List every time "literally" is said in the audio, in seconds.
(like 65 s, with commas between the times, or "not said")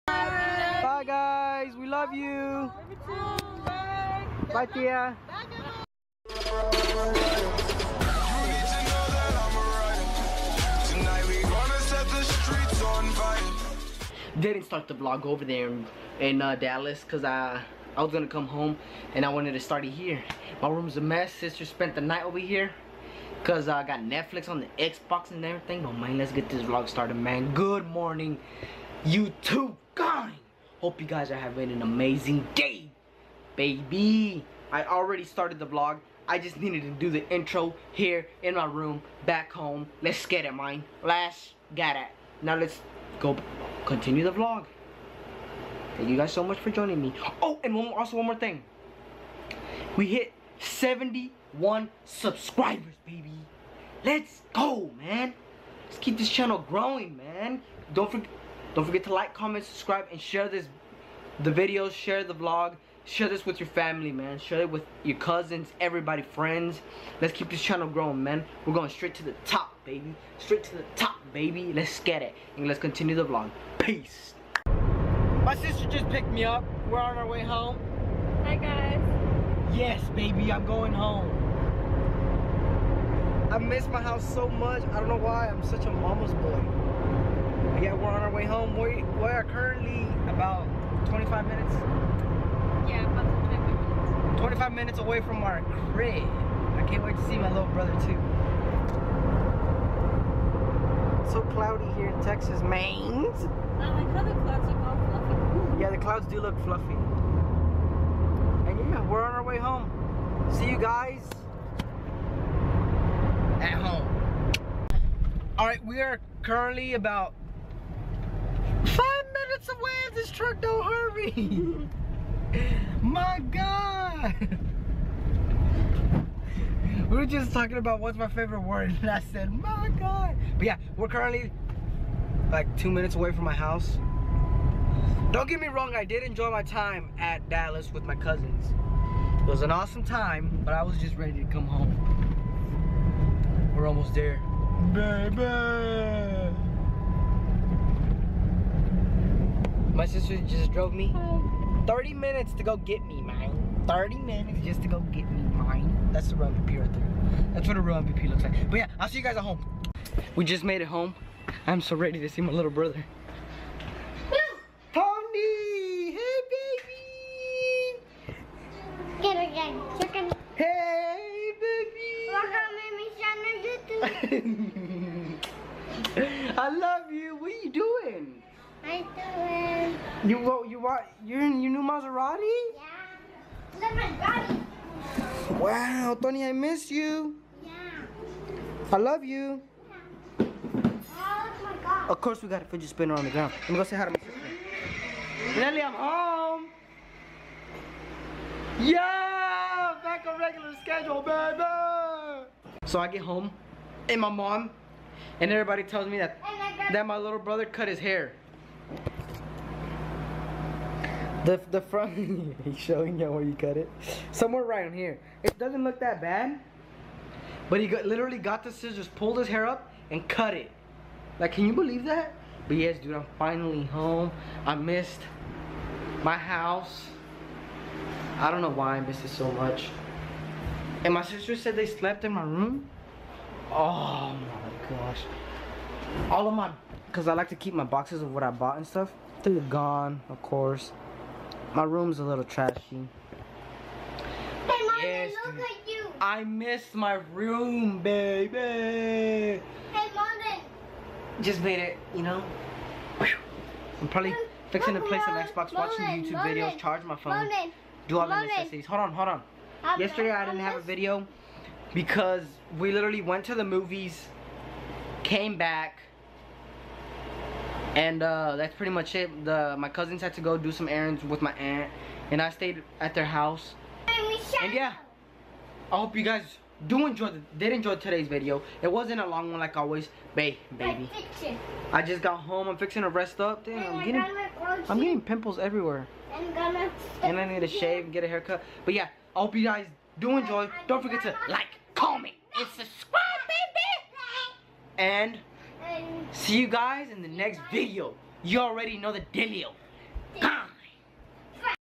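218 s, 262 s.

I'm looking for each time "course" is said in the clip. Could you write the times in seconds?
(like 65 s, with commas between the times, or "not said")
192 s, 240 s.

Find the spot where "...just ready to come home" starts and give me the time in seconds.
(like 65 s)
140 s.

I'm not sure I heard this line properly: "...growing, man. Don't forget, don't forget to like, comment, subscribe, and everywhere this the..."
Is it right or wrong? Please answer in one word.
wrong.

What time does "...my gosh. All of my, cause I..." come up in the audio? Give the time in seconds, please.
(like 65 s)
234 s.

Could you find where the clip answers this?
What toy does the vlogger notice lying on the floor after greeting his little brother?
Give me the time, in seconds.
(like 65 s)
192 s.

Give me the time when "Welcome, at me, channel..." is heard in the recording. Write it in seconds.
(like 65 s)
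173 s.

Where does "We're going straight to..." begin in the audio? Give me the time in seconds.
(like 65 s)
68 s.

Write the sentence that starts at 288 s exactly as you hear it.
But yeah, I hope you guys do enjoy.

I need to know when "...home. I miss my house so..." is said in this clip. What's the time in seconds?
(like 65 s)
80 s.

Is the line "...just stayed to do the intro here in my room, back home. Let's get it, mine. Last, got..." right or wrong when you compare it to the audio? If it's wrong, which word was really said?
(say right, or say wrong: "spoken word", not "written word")
wrong: "needed", not "stayed".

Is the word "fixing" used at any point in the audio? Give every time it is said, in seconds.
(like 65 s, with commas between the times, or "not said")
254 s, 282 s.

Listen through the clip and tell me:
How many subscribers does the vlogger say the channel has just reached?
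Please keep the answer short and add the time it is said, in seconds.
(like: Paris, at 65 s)
71, at 50 s.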